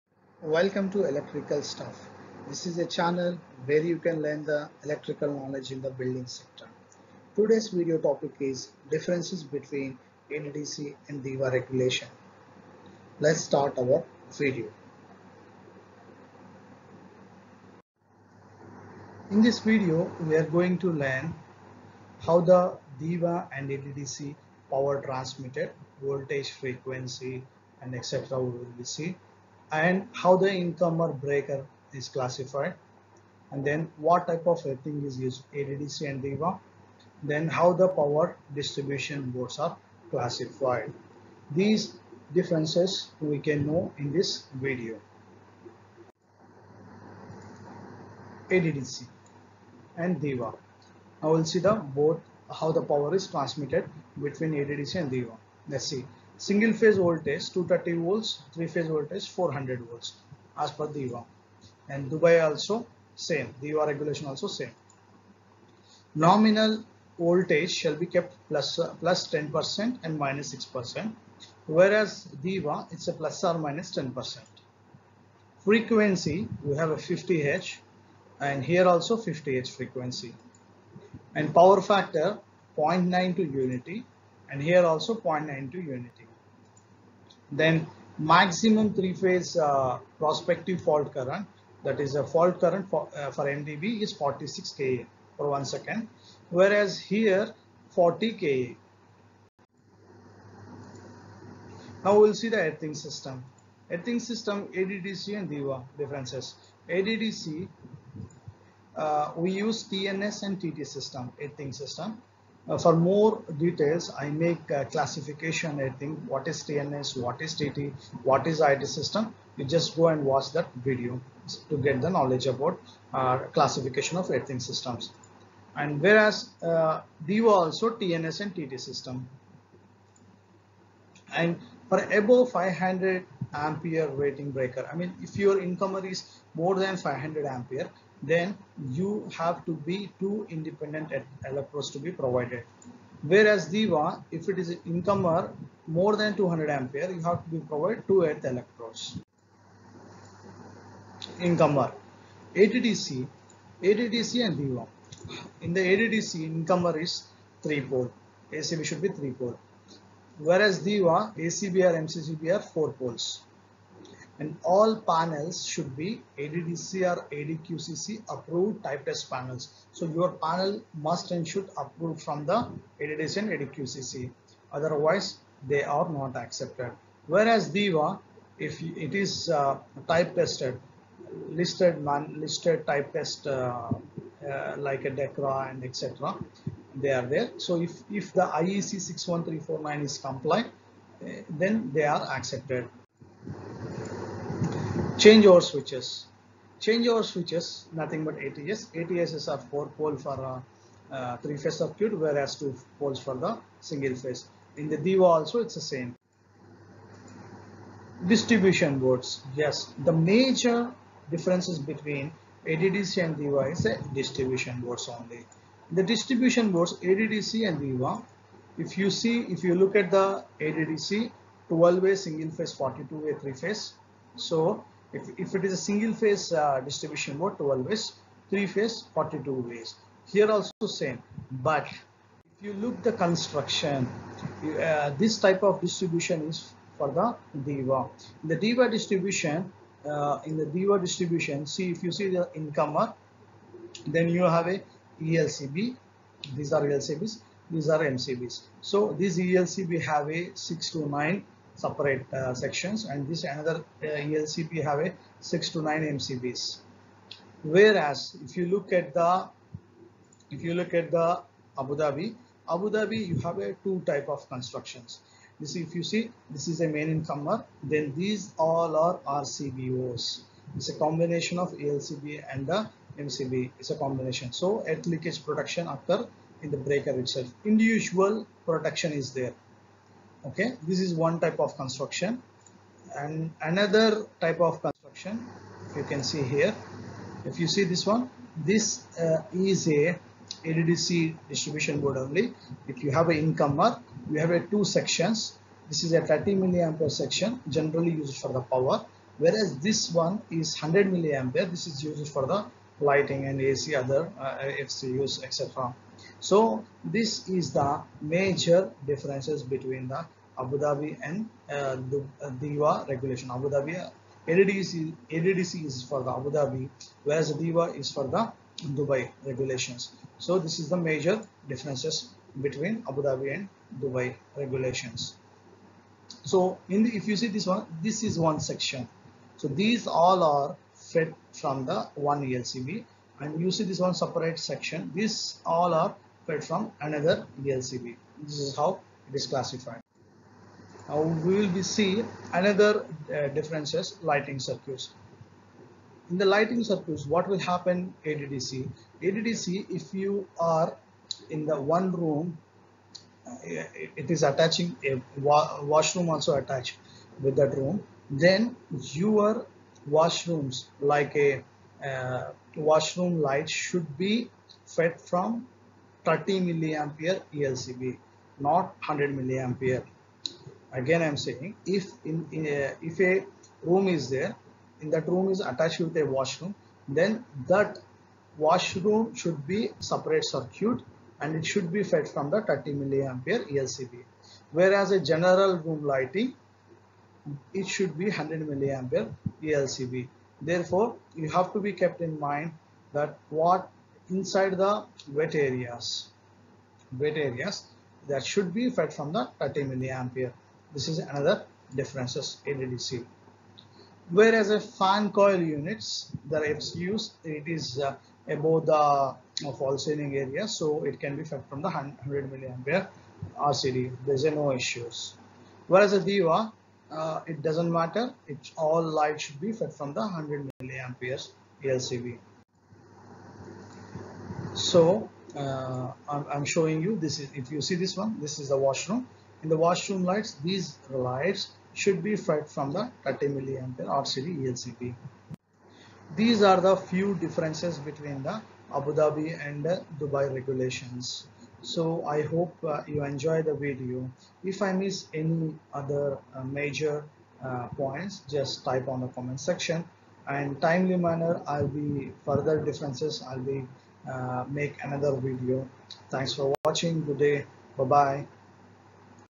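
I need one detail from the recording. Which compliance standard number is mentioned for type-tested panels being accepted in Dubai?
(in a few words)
IEC 61349.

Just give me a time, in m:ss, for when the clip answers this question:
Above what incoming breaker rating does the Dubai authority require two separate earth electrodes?
2:26.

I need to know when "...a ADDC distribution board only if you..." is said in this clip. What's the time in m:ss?
4:49.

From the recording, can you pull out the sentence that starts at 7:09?
In the washroom lights, these lights should be fed from the 30 milliampere RCD ELCB.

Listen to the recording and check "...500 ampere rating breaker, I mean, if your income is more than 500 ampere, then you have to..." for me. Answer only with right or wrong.
right.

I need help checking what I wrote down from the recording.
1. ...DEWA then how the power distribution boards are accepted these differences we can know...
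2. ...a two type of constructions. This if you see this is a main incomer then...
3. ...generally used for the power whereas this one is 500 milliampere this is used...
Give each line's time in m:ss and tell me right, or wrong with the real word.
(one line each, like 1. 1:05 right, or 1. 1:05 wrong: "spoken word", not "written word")
1. 0:36 wrong: "classified", not "accepted"
2. 4:23 right
3. 4:57 wrong: "100", not "500".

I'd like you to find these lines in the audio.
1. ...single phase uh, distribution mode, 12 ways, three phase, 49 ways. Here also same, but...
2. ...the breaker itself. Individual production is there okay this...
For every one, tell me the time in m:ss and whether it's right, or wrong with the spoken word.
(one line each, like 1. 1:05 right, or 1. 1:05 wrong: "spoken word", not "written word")
1. 3:45 wrong: "42", not "49"
2. 4:36 right.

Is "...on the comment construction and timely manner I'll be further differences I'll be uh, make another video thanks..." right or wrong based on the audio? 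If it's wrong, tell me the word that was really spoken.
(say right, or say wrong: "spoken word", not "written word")
wrong: "section", not "construction".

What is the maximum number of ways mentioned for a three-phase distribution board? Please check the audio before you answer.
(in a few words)
42.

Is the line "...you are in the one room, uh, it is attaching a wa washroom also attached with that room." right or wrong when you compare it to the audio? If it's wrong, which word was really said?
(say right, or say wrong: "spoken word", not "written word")
right.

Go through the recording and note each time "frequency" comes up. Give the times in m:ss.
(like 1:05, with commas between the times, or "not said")
0:26, 1:15, 1:19.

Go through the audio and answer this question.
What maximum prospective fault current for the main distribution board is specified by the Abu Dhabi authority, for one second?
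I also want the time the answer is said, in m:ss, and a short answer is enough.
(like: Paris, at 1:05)
46 kA, at 1:34.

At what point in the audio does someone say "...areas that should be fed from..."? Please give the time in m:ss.
6:37.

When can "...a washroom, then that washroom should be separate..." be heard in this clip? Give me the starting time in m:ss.
6:16.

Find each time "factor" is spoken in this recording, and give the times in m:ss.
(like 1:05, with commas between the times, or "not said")
1:21.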